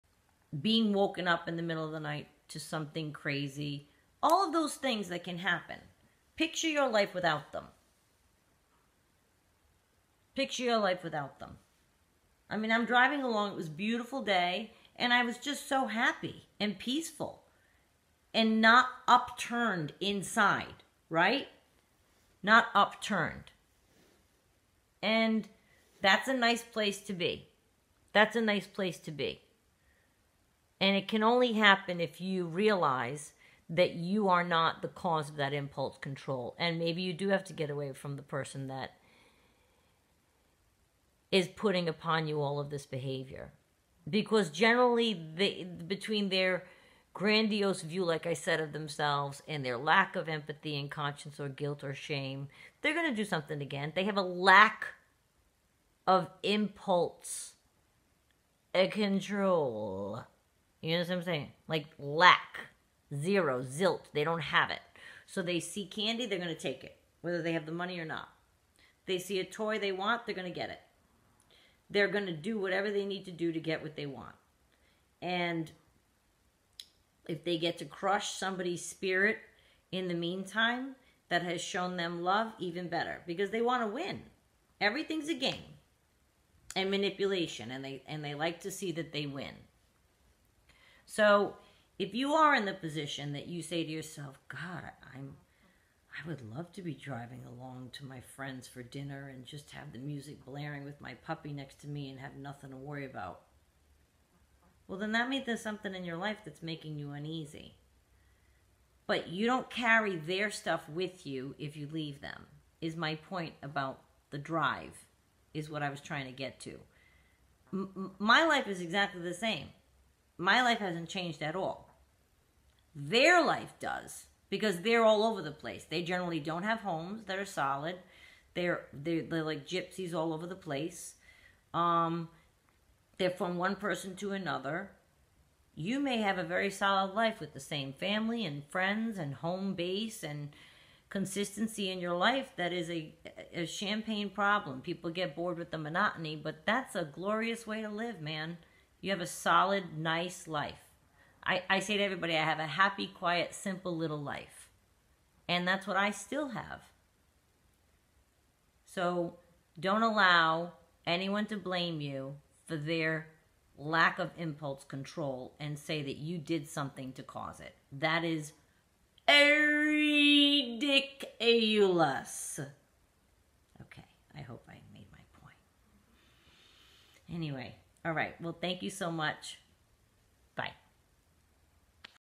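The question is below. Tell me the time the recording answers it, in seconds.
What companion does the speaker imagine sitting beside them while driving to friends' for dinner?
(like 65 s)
101 s.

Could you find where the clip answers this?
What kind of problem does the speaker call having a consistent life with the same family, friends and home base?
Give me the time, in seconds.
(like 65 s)
143 s.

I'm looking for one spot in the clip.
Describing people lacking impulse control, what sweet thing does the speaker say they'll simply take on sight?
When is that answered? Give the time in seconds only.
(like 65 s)
65 s.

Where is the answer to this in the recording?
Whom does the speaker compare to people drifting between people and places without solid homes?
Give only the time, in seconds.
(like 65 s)
129 s.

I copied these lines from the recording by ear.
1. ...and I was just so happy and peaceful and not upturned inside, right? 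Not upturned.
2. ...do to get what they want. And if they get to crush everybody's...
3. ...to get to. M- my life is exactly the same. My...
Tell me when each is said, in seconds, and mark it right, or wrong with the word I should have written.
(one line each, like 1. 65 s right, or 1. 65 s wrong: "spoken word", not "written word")
1. 14 s right
2. 73 s wrong: "somebody", not "everybody"
3. 116 s right.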